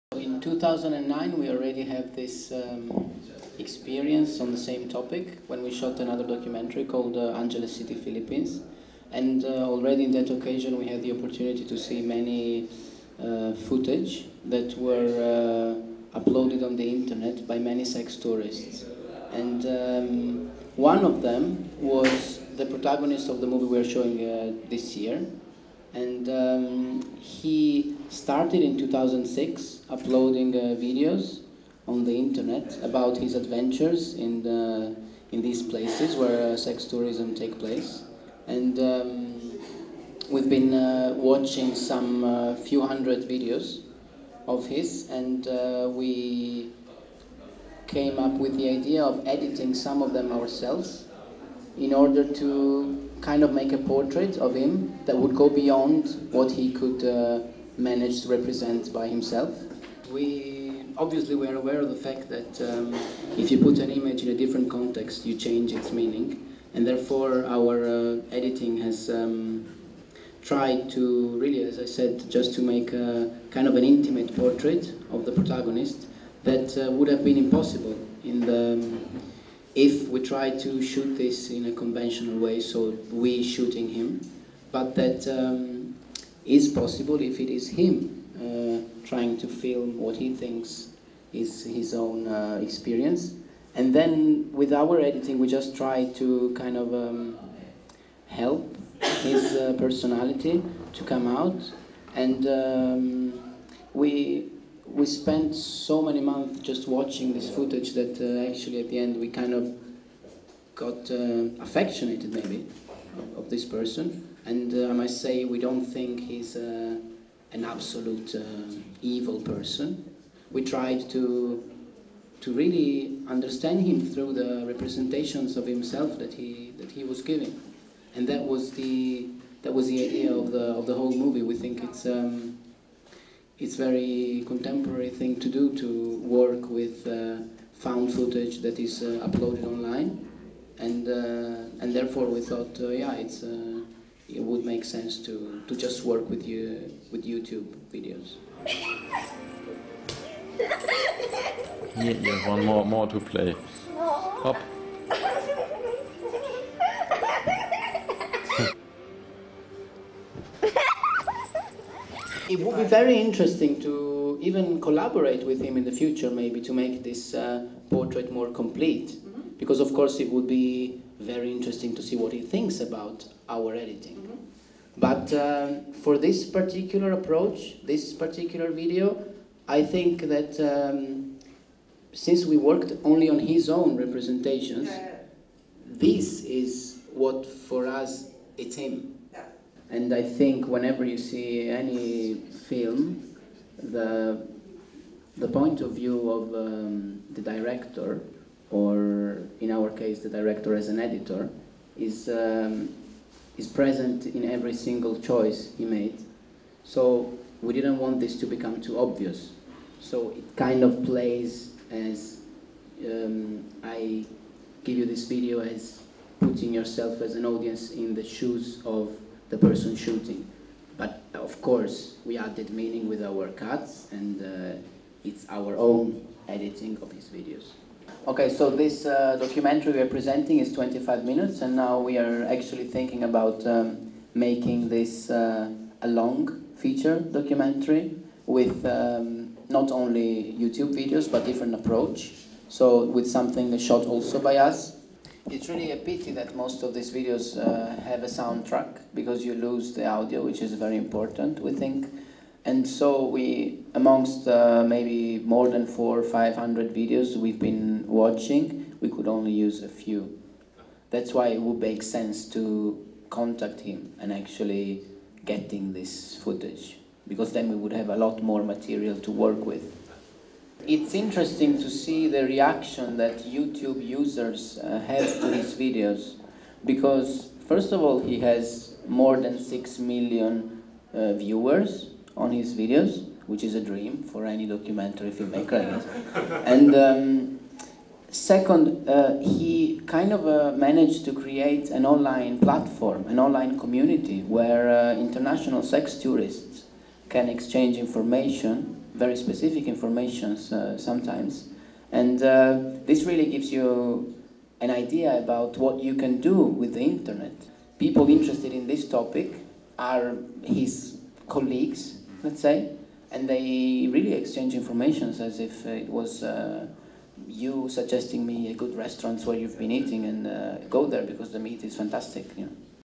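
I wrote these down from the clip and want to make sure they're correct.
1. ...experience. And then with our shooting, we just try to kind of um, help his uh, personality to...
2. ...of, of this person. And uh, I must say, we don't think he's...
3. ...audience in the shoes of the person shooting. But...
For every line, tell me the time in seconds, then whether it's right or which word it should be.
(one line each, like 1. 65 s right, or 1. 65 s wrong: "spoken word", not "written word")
1. 92 s wrong: "editing", not "shooting"
2. 113 s right
3. 217 s right.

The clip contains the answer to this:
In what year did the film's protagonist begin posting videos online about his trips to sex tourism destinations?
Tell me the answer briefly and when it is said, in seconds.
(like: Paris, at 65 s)
2006, at 28 s.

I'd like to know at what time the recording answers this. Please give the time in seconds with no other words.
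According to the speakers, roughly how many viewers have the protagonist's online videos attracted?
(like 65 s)
279 s.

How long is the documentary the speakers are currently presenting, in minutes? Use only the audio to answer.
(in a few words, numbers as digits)
25.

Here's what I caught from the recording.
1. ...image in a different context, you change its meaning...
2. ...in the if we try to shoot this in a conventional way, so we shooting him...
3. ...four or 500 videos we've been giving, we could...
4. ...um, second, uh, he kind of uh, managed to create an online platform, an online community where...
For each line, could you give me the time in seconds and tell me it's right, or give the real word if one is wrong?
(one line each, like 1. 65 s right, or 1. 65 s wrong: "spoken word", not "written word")
1. 63 s right
2. 78 s right
3. 255 s wrong: "watching", not "giving"
4. 286 s right.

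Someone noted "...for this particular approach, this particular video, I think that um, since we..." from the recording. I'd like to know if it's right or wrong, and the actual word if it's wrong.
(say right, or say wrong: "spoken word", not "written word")
right.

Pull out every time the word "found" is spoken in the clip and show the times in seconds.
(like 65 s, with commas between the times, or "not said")
137 s.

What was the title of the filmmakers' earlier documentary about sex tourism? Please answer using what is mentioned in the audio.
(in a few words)
Angeles City, Philippines.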